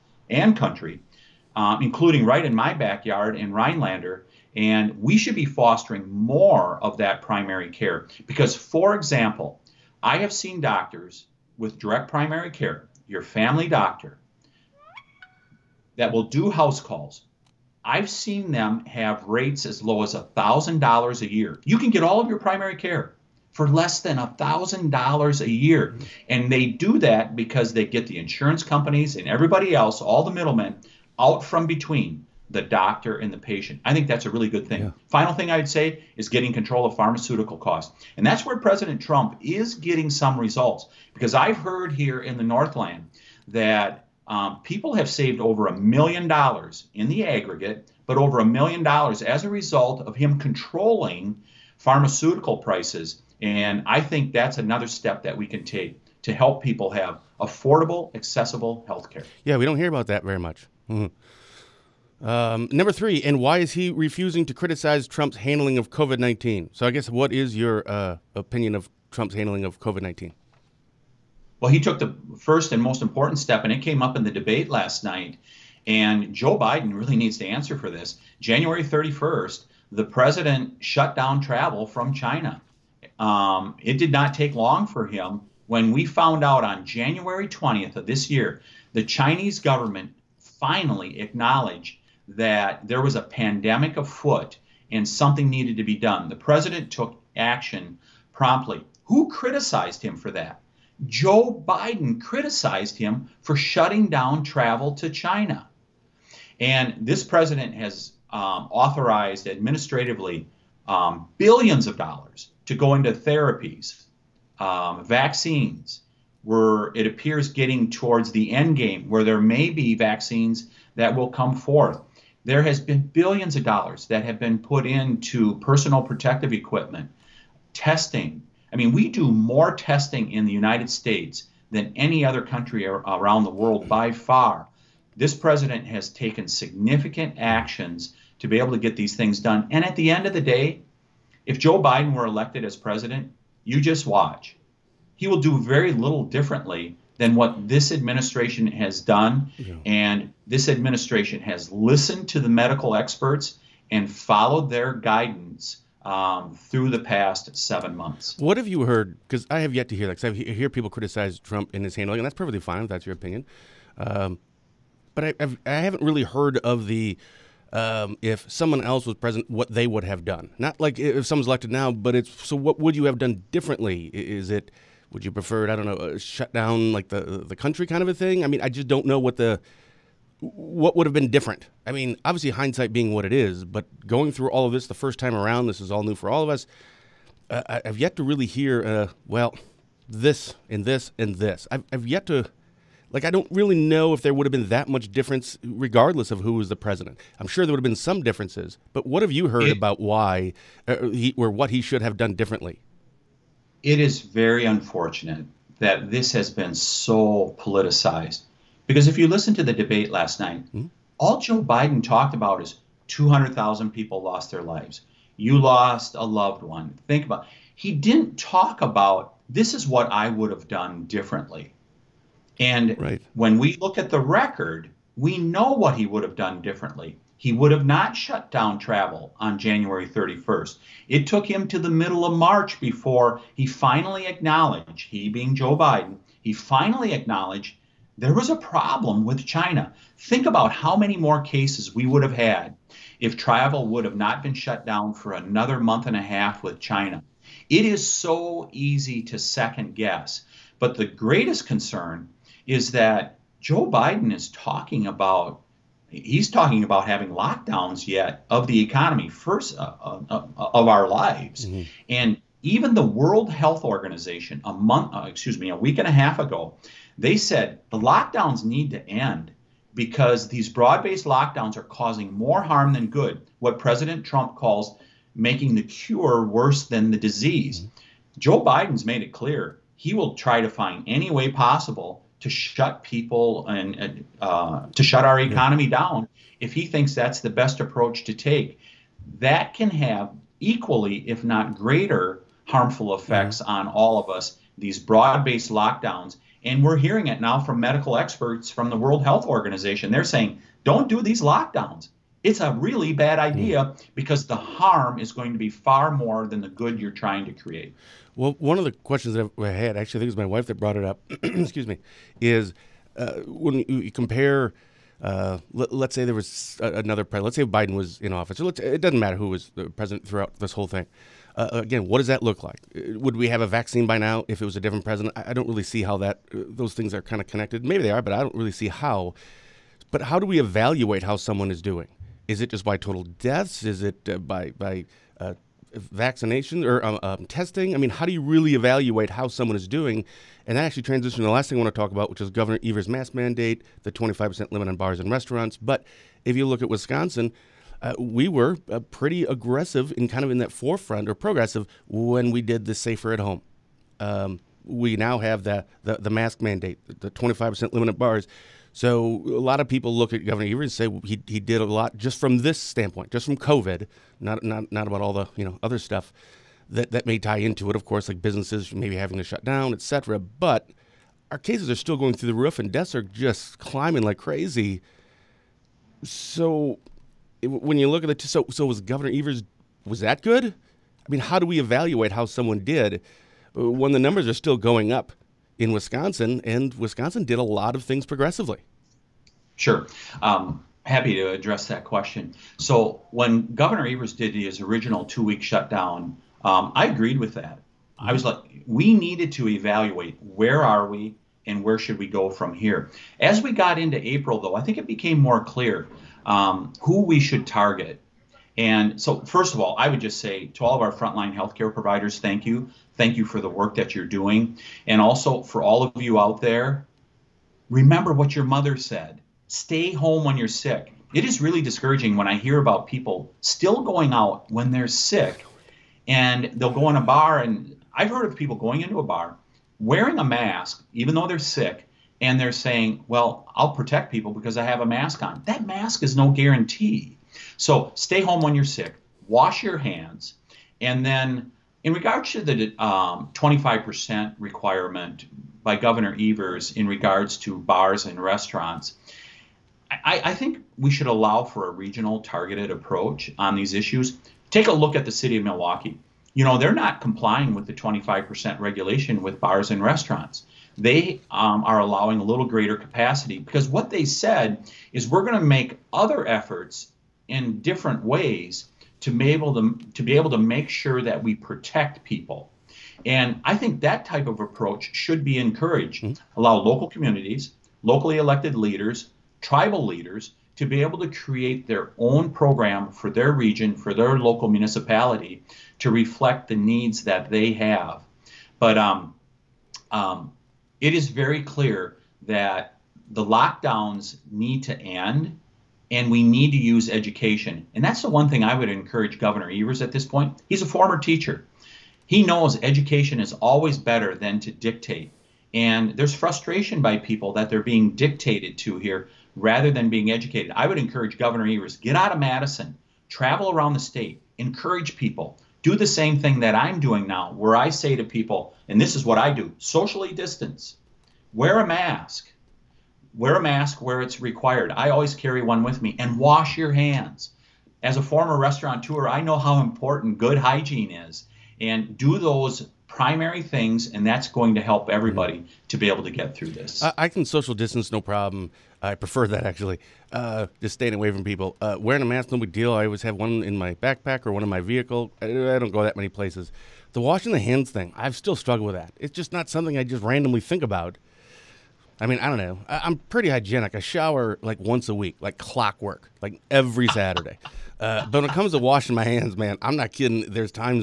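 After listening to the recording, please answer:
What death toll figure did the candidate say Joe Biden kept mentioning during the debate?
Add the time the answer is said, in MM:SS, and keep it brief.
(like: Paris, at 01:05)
200,000, at 03:33.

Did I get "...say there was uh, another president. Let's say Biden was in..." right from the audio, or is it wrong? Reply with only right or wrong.
right.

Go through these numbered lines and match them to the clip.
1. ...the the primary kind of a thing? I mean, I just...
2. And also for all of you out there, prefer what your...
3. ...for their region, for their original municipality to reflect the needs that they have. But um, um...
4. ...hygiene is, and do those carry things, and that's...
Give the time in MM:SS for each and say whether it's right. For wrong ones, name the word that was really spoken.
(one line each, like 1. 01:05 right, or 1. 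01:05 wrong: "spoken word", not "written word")
1. 02:57 wrong: "country", not "primary"
2. 06:55 wrong: "remember", not "prefer"
3. 08:03 wrong: "local", not "original"
4. 08:50 wrong: "primary", not "carry".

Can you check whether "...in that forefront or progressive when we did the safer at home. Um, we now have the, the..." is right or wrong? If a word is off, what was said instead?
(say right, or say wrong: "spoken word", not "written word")
right.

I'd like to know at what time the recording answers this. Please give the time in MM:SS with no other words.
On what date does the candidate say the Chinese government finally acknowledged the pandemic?
01:26.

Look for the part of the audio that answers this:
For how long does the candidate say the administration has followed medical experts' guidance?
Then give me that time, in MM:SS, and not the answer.
02:36.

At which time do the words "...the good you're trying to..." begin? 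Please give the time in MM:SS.
05:06.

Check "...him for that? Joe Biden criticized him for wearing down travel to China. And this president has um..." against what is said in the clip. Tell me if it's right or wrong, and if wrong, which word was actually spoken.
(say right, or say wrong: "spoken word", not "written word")
wrong: "shutting", not "wearing".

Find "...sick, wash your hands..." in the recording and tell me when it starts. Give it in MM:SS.
07:18.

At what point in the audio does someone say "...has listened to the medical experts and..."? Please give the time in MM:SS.
02:31.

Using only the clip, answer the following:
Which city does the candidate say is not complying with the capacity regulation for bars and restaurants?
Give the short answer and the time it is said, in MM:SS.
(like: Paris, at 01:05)
Milwaukee, at 07:35.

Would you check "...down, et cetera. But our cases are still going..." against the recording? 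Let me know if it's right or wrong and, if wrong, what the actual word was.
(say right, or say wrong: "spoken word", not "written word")
right.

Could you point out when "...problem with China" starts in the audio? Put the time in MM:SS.
03:58.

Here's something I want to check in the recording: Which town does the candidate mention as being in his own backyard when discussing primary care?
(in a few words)
Rhinelander.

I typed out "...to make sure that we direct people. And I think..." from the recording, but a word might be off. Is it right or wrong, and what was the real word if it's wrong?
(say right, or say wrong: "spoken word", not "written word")
wrong: "protect", not "direct".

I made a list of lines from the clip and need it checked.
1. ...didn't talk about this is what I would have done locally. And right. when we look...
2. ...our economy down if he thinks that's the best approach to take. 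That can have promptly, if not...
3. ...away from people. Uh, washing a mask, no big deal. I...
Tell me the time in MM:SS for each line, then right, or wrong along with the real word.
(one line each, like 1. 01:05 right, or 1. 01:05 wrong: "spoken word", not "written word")
1. 03:37 wrong: "differently", not "locally"
2. 04:45 wrong: "equally", not "promptly"
3. 09:01 wrong: "wearing", not "washing".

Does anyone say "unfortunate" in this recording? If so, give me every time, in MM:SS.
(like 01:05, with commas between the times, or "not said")
03:24.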